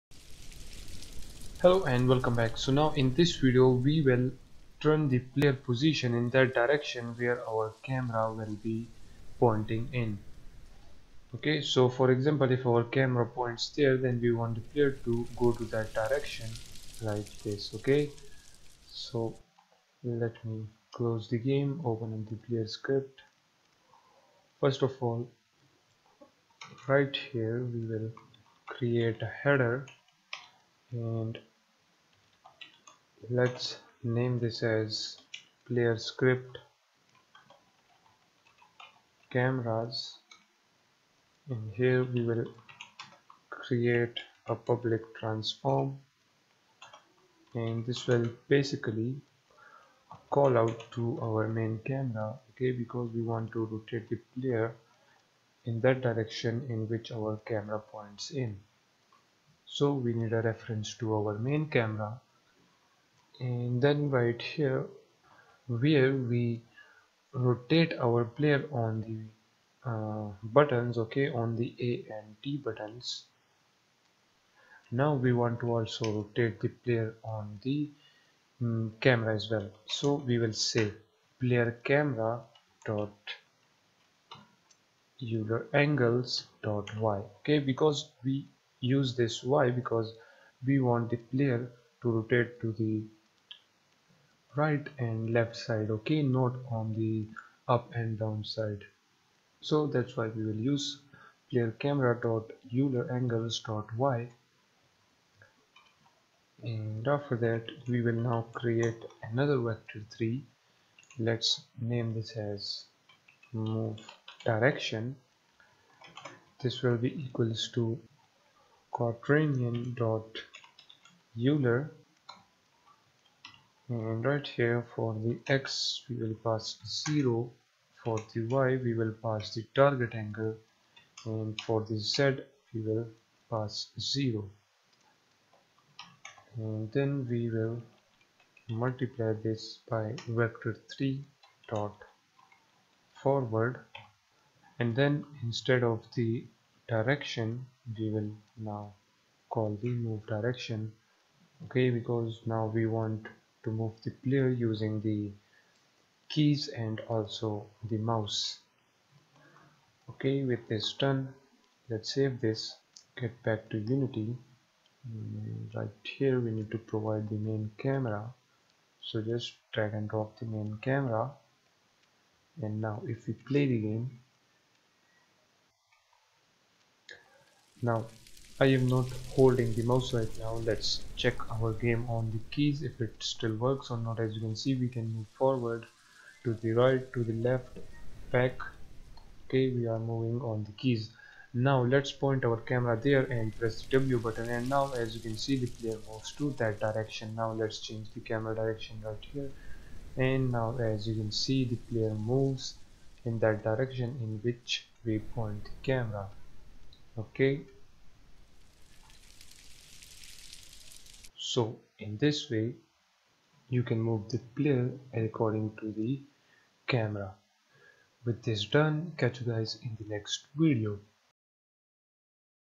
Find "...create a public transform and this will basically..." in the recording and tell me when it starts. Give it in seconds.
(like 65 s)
43 s.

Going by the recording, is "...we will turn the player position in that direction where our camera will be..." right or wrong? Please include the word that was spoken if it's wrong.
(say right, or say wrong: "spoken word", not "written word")
right.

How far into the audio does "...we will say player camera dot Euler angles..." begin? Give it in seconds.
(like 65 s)
80 s.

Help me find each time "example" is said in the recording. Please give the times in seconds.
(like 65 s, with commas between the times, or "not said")
12 s.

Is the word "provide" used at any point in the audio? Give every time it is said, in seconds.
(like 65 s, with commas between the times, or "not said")
166 s.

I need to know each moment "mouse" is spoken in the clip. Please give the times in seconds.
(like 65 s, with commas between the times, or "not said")
158 s, 179 s.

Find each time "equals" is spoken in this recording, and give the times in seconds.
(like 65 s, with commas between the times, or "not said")
117 s.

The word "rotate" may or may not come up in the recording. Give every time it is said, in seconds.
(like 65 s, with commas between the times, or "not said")
53 s, 67 s, 76 s, 92 s.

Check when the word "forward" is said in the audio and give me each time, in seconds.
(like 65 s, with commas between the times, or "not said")
143 s, 185 s.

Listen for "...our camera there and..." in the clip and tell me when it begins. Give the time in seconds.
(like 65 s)
192 s.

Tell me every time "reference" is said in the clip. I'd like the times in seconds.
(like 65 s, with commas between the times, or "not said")
60 s.